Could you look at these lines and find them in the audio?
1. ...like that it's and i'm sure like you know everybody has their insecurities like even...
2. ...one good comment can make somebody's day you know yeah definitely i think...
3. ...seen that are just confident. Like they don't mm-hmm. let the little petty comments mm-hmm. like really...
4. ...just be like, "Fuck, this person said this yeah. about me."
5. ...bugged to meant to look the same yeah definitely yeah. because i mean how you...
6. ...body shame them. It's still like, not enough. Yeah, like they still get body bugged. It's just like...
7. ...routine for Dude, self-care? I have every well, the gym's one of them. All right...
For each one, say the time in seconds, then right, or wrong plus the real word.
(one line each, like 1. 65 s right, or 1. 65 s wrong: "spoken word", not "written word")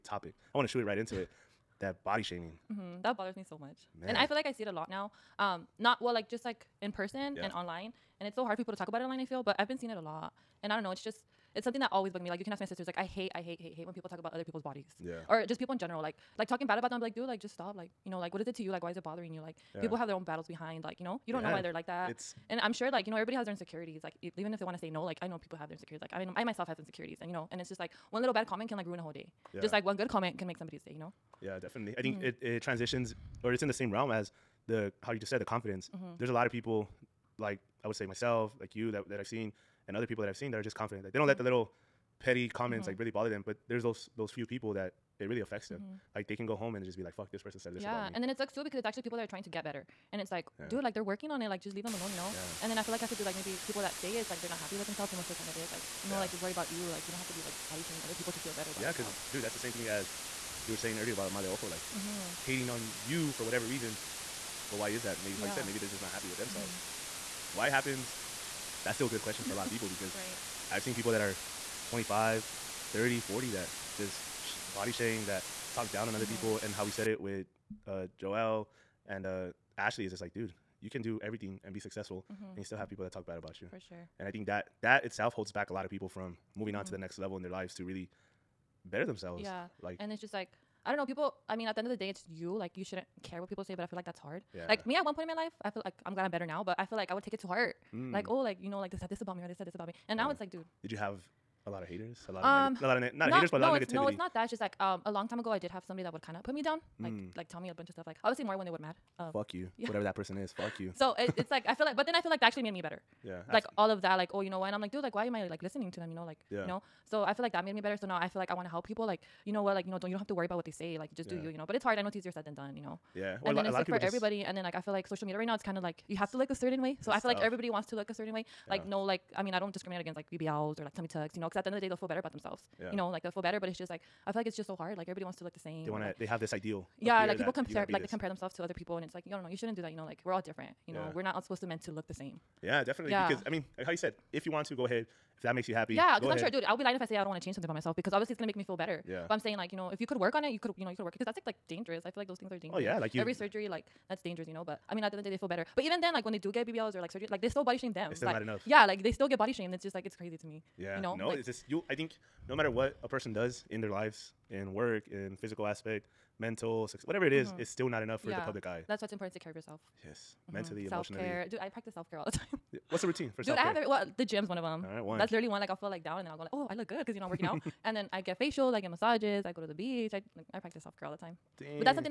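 1. 21 s right
2. 29 s right
3. 40 s right
4. 46 s right
5. 141 s wrong: "supposed", not "bugged"
6. 157 s wrong: "shamed", not "bugged"
7. 173 s right.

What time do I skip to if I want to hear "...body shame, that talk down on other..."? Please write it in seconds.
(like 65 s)
74 s.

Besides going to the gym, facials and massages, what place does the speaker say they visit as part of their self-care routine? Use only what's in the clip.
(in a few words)
the beach.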